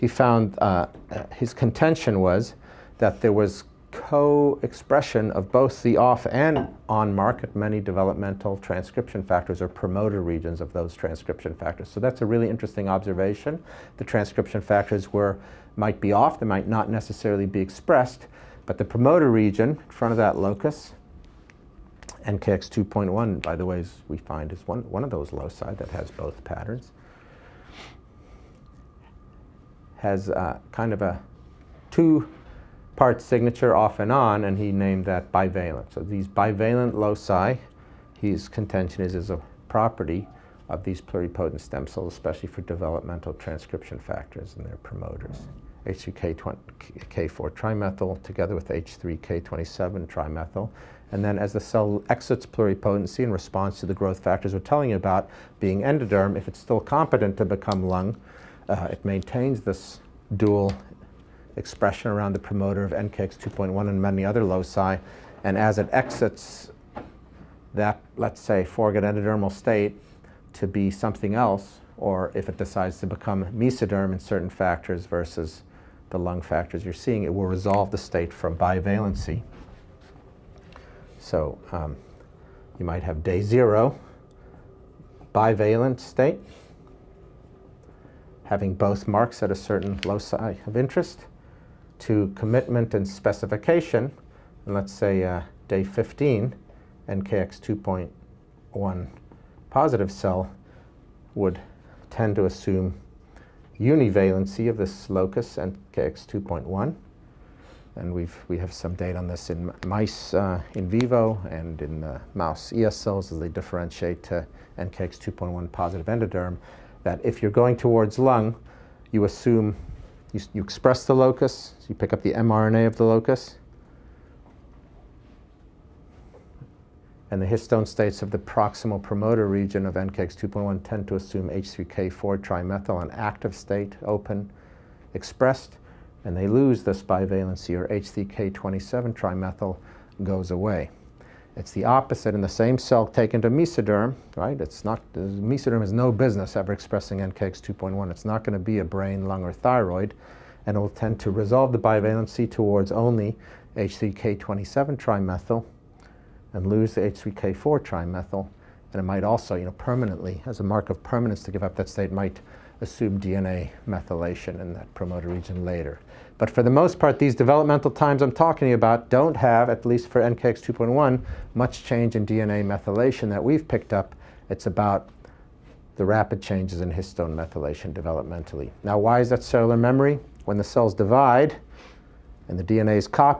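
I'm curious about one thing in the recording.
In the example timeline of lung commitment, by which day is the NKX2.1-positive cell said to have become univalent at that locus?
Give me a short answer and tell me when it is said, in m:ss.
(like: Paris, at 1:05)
day 15, at 1:35.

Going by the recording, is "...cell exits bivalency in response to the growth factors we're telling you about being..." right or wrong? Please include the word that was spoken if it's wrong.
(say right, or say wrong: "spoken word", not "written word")
wrong: "pluripotency", not "bivalency".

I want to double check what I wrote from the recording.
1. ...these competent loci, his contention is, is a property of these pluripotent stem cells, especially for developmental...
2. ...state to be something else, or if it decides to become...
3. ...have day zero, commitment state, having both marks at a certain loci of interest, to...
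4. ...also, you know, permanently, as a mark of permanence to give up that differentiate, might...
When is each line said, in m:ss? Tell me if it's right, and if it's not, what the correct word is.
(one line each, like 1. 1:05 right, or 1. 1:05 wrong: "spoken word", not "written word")
1. 0:36 wrong: "bivalent", not "competent"
2. 1:09 right
3. 1:23 wrong: "bivalent", not "commitment"
4. 2:39 wrong: "state", not "differentiate".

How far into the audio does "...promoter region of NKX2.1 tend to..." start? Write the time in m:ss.
2:09.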